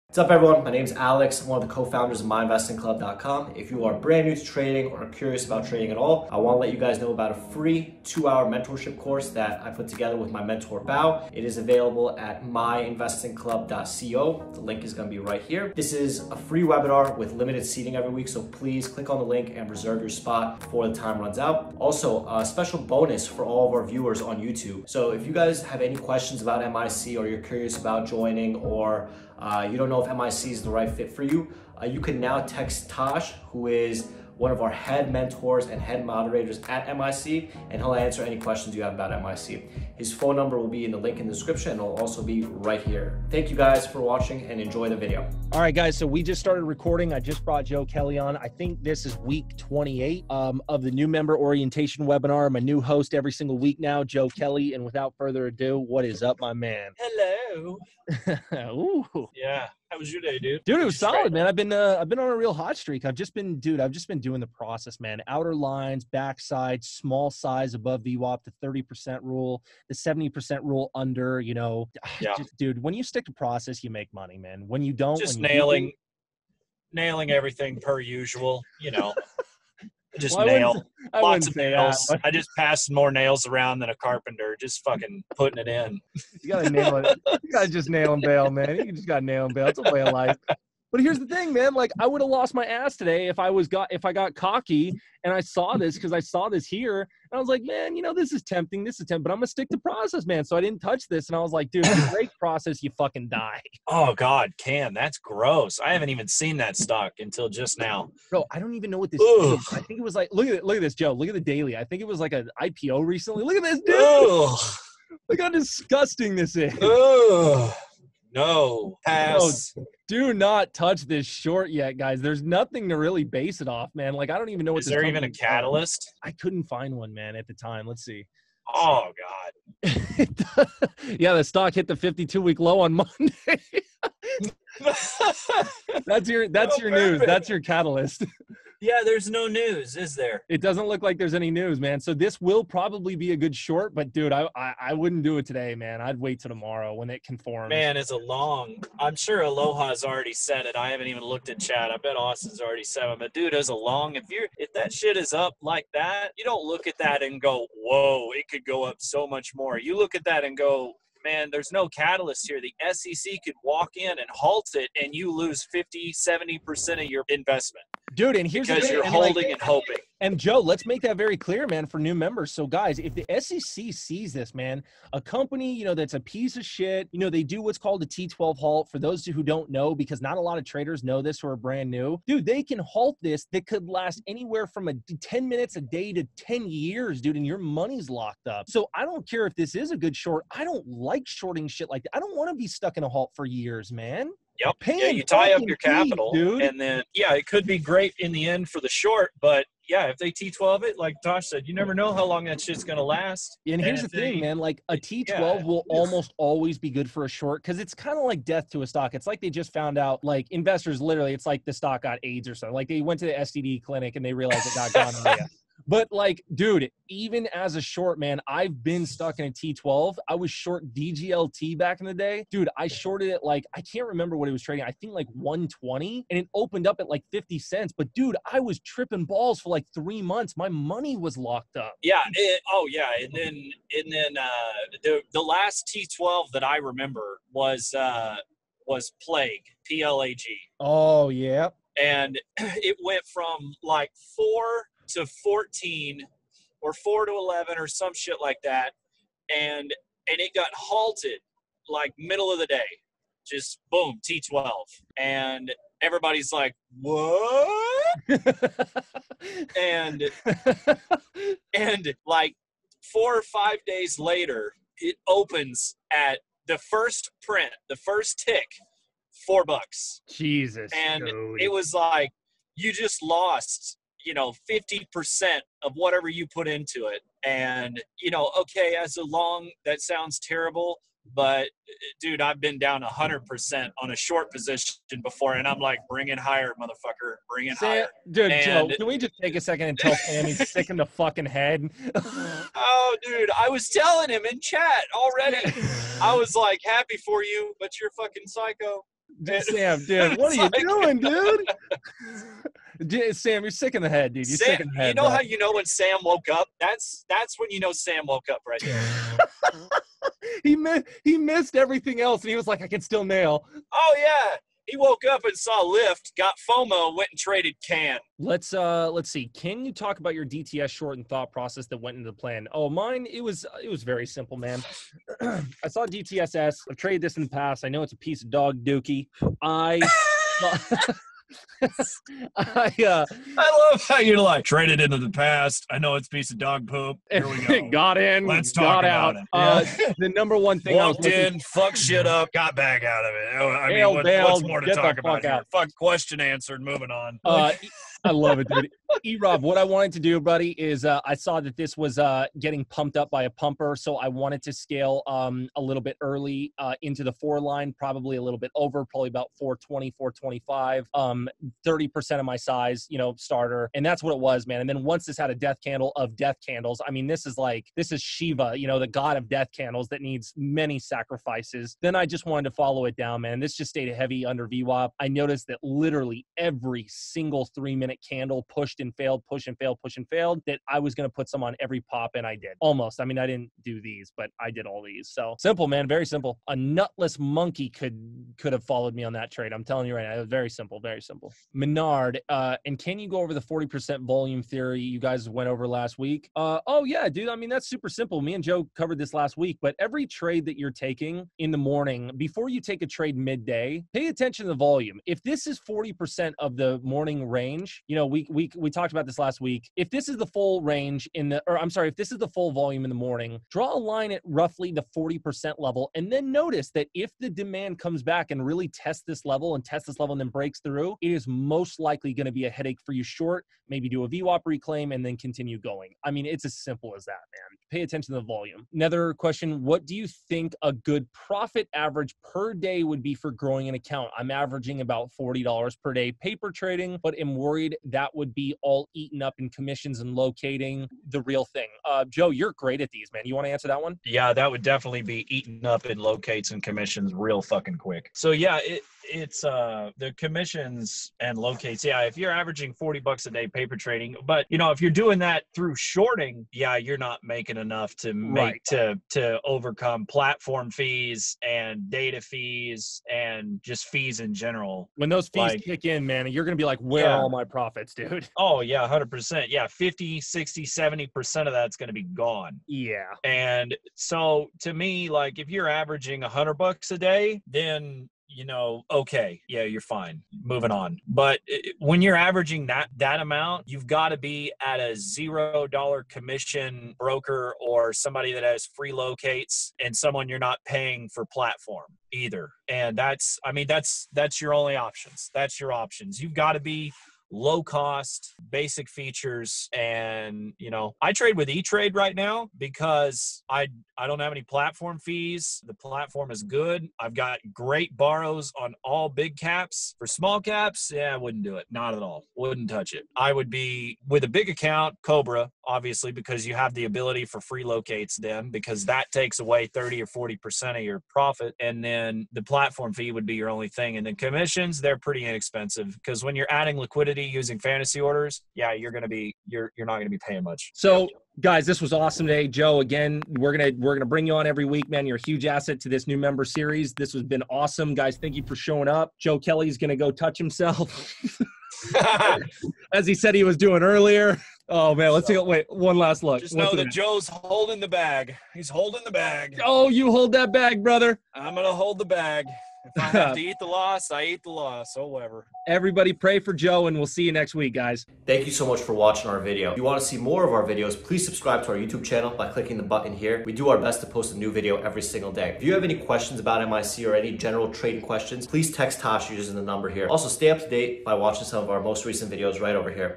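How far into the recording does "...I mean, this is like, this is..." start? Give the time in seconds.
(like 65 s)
367 s.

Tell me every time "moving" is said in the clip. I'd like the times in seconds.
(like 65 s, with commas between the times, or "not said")
346 s, 480 s.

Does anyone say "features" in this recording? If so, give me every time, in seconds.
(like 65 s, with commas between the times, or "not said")
499 s.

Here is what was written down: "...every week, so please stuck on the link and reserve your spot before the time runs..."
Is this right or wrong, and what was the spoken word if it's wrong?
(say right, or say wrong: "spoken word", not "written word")
wrong: "click", not "stuck".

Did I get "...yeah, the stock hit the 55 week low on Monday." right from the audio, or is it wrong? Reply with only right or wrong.
wrong.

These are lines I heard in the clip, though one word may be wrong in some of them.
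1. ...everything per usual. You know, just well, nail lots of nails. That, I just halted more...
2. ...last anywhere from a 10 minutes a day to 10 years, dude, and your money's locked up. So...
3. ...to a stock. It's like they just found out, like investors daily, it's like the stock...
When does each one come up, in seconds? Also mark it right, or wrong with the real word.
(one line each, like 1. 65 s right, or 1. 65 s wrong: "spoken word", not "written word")
1. 77 s wrong: "passed", not "halted"
2. 183 s right
3. 208 s wrong: "literally", not "daily".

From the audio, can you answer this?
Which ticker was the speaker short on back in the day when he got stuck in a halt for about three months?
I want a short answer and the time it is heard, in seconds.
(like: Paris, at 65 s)
DGLT, at 220 s.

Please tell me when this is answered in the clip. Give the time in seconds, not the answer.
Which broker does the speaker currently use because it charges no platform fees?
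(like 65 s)
501 s.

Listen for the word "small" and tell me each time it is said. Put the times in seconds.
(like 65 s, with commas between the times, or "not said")
66 s, 510 s.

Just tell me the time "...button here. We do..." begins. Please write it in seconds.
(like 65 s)
563 s.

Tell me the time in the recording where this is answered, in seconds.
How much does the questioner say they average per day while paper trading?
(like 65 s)
435 s.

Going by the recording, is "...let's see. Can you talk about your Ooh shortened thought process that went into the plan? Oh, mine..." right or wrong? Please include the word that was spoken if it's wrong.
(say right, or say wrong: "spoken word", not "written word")
wrong: "DTS", not "Ooh".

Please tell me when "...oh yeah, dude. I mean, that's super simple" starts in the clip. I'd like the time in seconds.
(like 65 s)
396 s.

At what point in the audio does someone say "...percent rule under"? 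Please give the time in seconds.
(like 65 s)
70 s.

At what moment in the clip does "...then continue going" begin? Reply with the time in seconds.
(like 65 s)
425 s.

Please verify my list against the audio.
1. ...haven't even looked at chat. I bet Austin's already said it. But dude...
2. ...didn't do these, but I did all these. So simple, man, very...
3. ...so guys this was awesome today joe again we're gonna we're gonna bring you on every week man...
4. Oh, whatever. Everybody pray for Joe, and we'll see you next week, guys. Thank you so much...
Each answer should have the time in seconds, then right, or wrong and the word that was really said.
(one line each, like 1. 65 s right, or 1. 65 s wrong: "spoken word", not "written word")
1. 150 s right
2. 383 s right
3. 530 s right
4. 555 s right.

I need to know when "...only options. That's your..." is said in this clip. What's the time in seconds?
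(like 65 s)
494 s.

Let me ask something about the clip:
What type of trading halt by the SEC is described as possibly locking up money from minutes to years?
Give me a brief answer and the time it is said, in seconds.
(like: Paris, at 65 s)
T12 halt, at 178 s.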